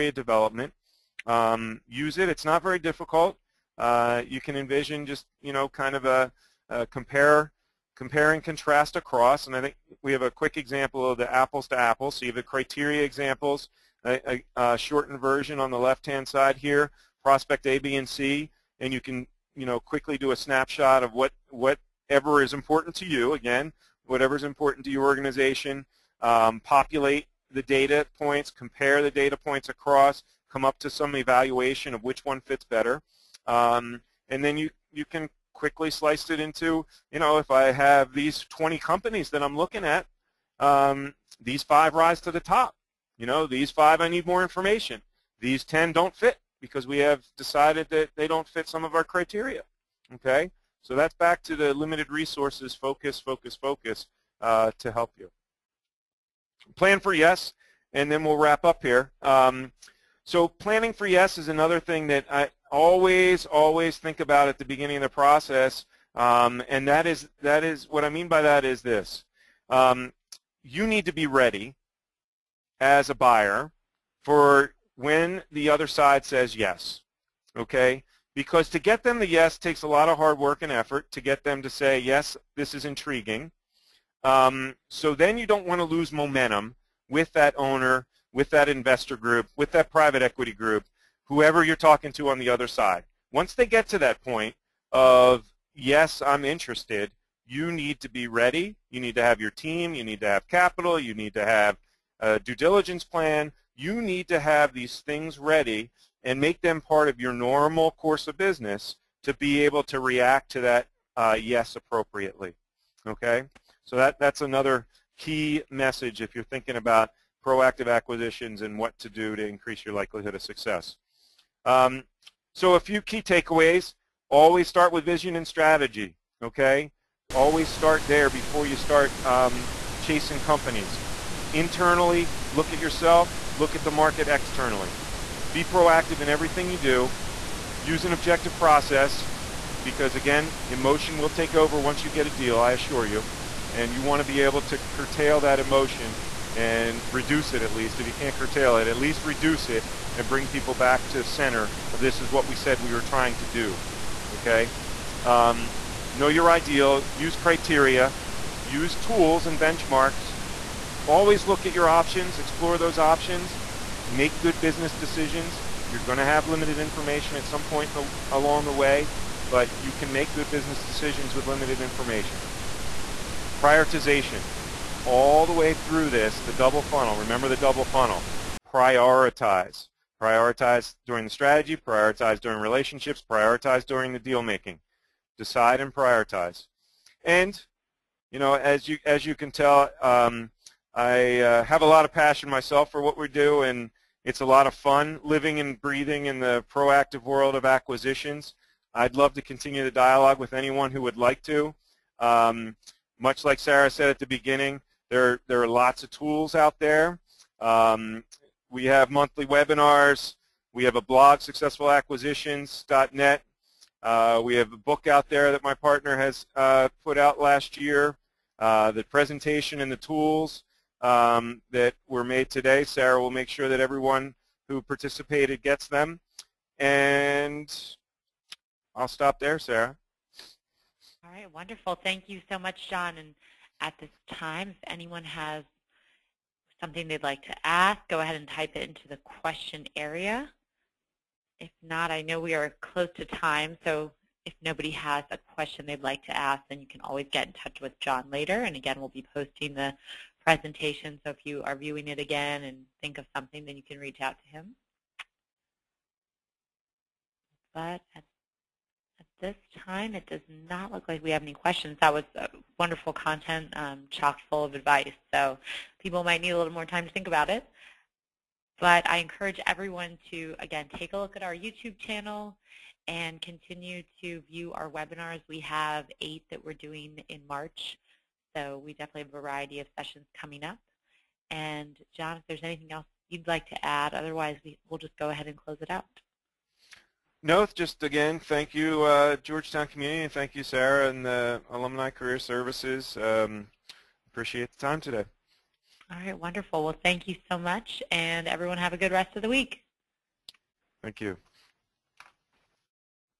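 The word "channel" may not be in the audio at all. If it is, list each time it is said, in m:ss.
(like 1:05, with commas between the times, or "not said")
4:31.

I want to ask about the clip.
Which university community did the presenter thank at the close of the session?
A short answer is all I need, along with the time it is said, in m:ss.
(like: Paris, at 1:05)
Georgetown, at 4:49.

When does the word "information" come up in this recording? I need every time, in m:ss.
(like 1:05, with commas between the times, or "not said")
0:44, 2:46, 2:51.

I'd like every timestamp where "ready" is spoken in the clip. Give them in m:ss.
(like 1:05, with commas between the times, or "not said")
1:11, 1:38, 1:45.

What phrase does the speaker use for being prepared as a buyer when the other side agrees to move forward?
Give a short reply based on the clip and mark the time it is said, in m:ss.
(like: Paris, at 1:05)
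Plan for yes, at 0:56.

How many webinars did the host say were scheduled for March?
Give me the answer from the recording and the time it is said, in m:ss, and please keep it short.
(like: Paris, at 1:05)
8, at 4:36.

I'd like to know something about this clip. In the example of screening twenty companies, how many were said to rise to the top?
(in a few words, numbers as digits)
5.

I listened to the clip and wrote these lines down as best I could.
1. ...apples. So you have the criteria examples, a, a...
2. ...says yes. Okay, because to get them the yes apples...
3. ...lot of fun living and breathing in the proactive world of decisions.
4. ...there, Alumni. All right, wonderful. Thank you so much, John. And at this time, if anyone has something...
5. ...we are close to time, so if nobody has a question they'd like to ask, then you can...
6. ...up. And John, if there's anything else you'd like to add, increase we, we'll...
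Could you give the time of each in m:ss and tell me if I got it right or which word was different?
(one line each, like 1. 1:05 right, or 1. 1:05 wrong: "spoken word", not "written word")
1. 0:11 right
2. 1:16 wrong: "takes", not "apples"
3. 3:14 wrong: "acquisitions", not "decisions"
4. 3:49 wrong: "Sarah", not "Alumni"
5. 4:02 right
6. 4:40 wrong: "otherwise", not "increase".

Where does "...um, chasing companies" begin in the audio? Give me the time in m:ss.
2:09.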